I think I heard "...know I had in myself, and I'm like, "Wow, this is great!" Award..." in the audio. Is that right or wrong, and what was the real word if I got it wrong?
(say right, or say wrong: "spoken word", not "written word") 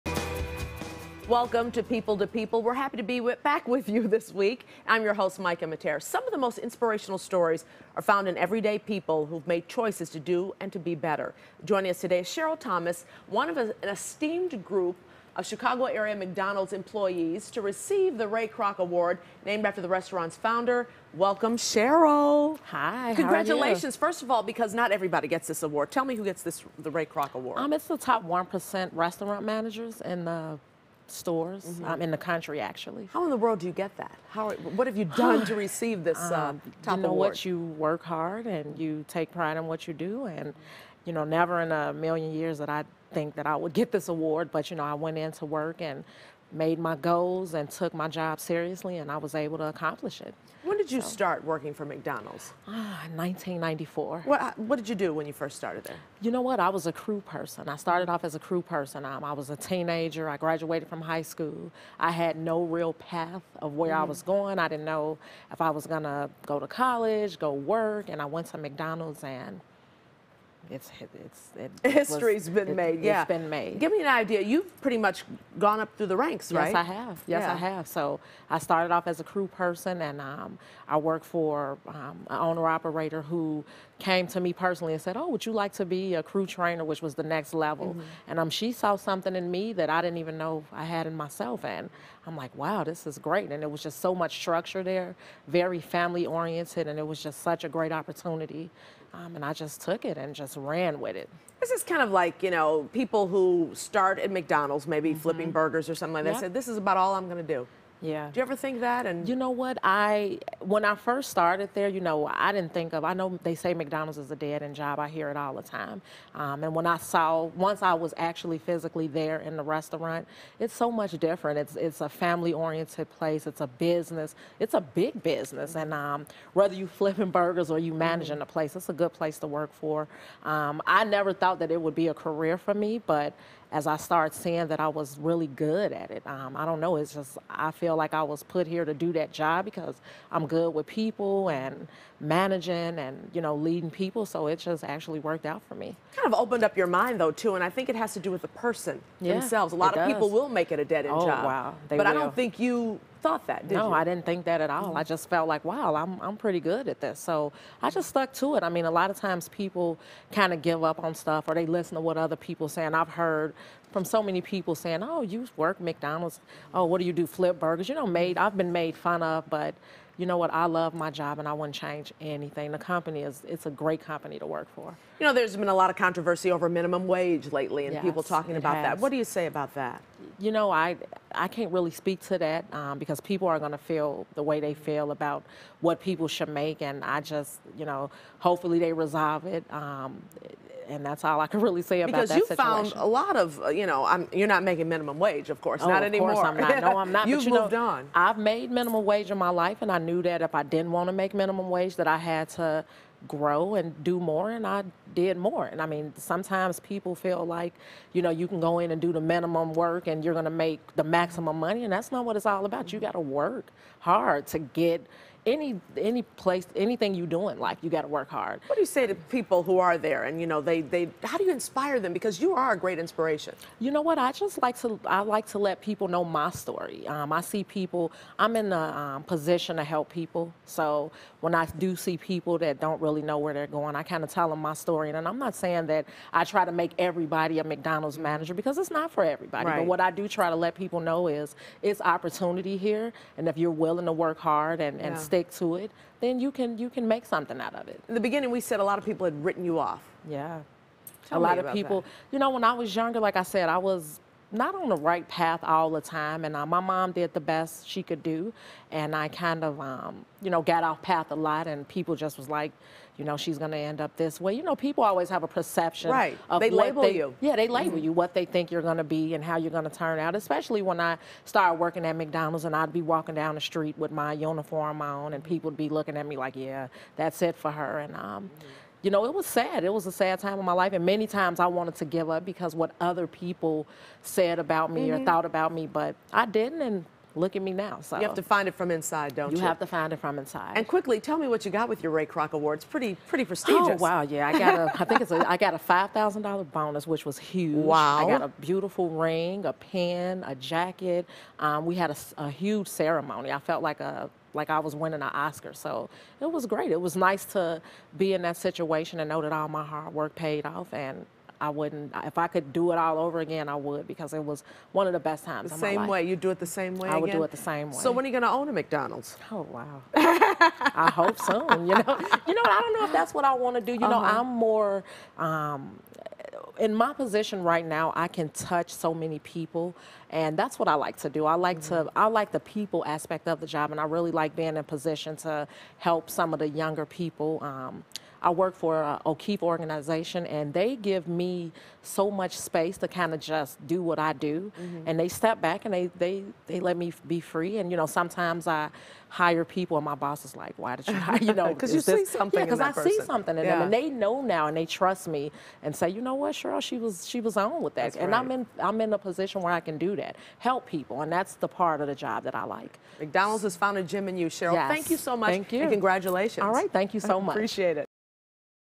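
wrong: "And", not "Award".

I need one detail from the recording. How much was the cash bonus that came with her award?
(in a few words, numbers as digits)
$5,000.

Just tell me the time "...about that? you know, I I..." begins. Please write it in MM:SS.
02:59.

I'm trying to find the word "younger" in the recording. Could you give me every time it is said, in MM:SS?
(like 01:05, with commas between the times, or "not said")
04:12, 05:36.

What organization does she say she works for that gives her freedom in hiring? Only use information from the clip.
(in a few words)
O'Keefe.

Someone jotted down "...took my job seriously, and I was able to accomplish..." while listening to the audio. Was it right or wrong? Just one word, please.
right.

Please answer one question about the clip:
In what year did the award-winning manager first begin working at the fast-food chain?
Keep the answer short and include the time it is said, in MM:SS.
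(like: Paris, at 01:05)
1994, at 00:53.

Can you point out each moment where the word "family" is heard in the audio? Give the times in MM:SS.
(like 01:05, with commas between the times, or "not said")
01:35, 02:02.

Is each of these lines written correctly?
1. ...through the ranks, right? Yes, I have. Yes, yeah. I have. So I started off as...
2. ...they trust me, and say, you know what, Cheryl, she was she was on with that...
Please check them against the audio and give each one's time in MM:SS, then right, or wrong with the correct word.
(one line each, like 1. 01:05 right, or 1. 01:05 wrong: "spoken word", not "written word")
1. 01:15 right
2. 05:54 right.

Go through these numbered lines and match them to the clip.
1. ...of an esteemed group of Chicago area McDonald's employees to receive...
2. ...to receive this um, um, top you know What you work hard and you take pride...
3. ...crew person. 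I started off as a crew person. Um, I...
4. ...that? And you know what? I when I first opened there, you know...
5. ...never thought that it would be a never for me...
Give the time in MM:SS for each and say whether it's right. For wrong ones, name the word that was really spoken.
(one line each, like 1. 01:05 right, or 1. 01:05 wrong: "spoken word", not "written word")
1. 00:13 right
2. 00:35 right
3. 00:56 right
4. 01:48 wrong: "started", not "opened"
5. 02:11 wrong: "career", not "never".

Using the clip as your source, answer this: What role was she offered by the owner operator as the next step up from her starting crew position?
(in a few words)
Crew trainer.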